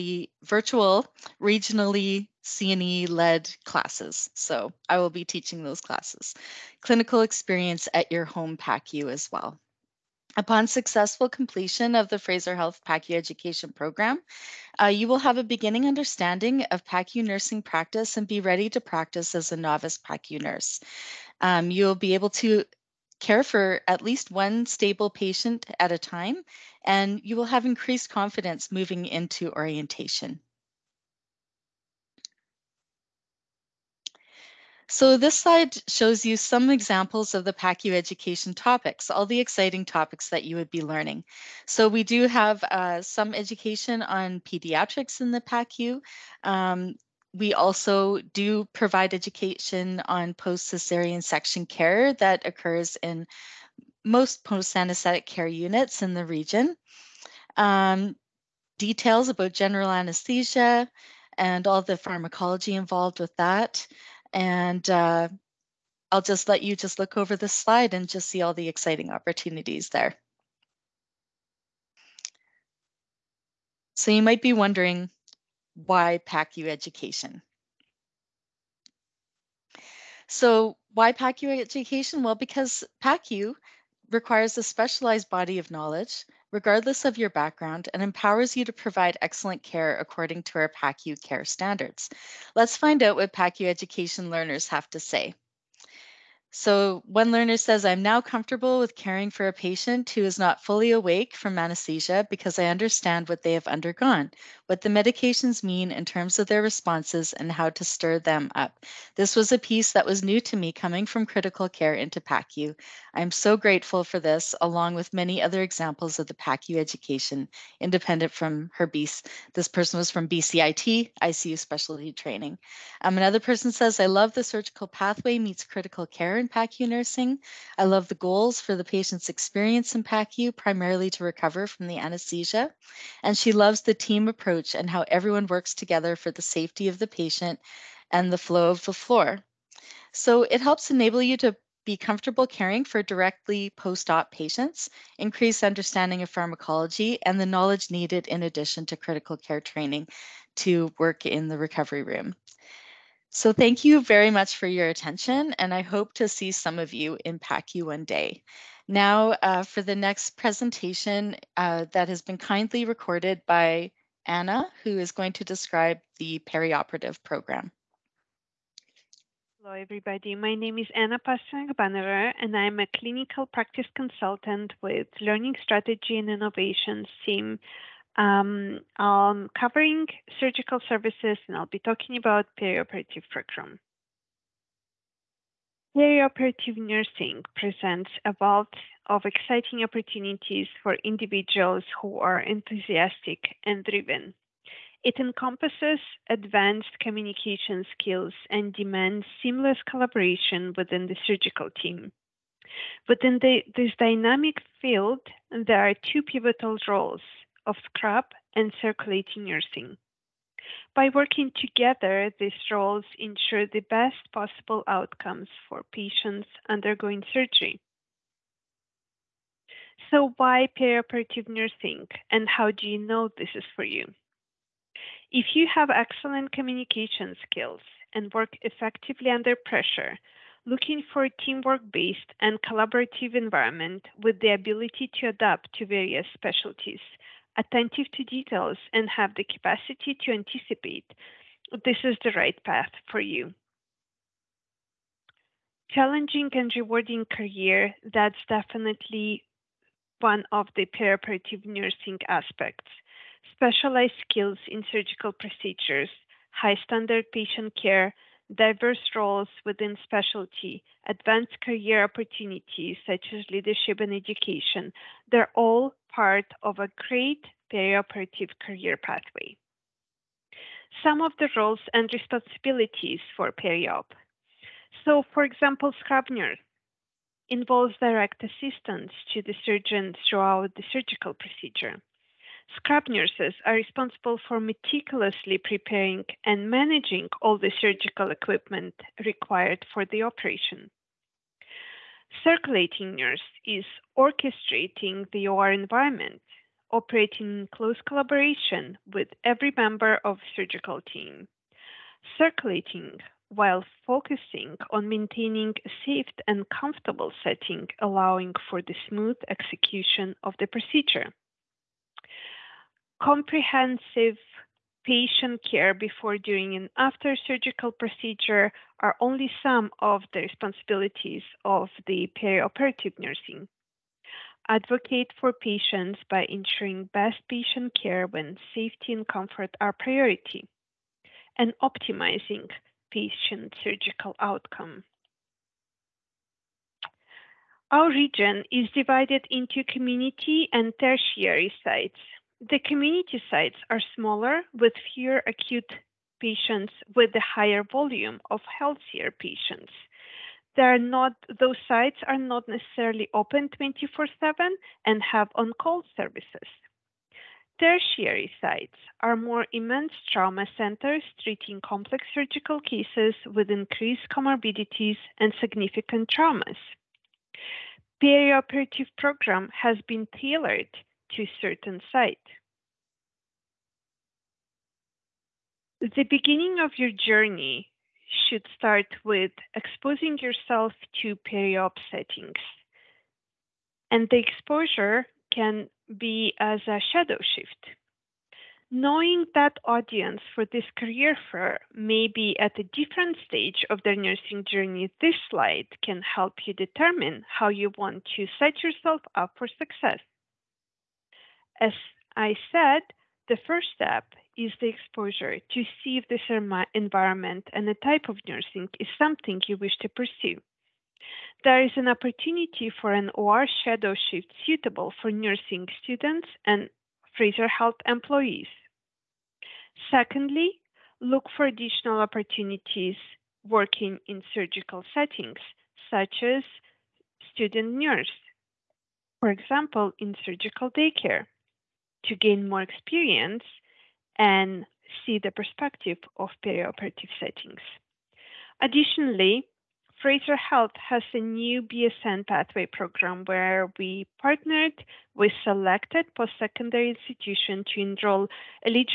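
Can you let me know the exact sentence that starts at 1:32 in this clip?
Let's find out what PACU education learners have to say.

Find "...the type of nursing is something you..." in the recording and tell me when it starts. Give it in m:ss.
6:47.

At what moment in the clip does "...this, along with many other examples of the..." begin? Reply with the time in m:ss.
1:54.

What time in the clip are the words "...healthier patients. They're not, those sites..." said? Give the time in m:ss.
5:48.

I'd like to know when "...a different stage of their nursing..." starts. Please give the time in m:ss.
6:32.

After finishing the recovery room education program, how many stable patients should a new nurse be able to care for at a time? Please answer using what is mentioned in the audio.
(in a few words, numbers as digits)
1.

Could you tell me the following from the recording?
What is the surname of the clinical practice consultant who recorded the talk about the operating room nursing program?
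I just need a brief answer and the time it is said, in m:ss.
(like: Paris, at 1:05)
Pasternak Bannerer, at 2:51.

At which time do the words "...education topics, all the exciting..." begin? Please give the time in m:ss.
0:37.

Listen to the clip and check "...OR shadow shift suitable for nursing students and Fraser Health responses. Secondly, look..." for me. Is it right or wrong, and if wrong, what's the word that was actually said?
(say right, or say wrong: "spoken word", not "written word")
wrong: "employees", not "responses".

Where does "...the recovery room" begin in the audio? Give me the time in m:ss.
2:31.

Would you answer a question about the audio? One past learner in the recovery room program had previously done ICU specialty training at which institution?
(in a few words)
BCIT.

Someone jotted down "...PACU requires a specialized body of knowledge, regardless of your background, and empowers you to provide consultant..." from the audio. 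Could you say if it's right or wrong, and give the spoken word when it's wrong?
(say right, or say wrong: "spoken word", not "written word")
wrong: "excellent", not "consultant".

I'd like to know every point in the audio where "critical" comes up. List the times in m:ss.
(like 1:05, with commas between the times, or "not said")
1:51, 2:05, 2:28.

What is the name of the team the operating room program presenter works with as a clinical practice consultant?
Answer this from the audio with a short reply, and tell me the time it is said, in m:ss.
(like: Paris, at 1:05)
Learning Strategy and Innovations, at 2:55.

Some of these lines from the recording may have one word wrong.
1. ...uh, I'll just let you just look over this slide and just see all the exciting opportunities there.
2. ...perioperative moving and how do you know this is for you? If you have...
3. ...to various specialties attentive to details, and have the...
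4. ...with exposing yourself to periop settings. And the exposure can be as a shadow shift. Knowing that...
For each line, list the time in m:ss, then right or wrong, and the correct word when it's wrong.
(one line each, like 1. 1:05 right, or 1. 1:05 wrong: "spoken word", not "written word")
1. 1:04 right
2. 3:40 wrong: "nursing", not "moving"
3. 3:55 right
4. 6:19 right.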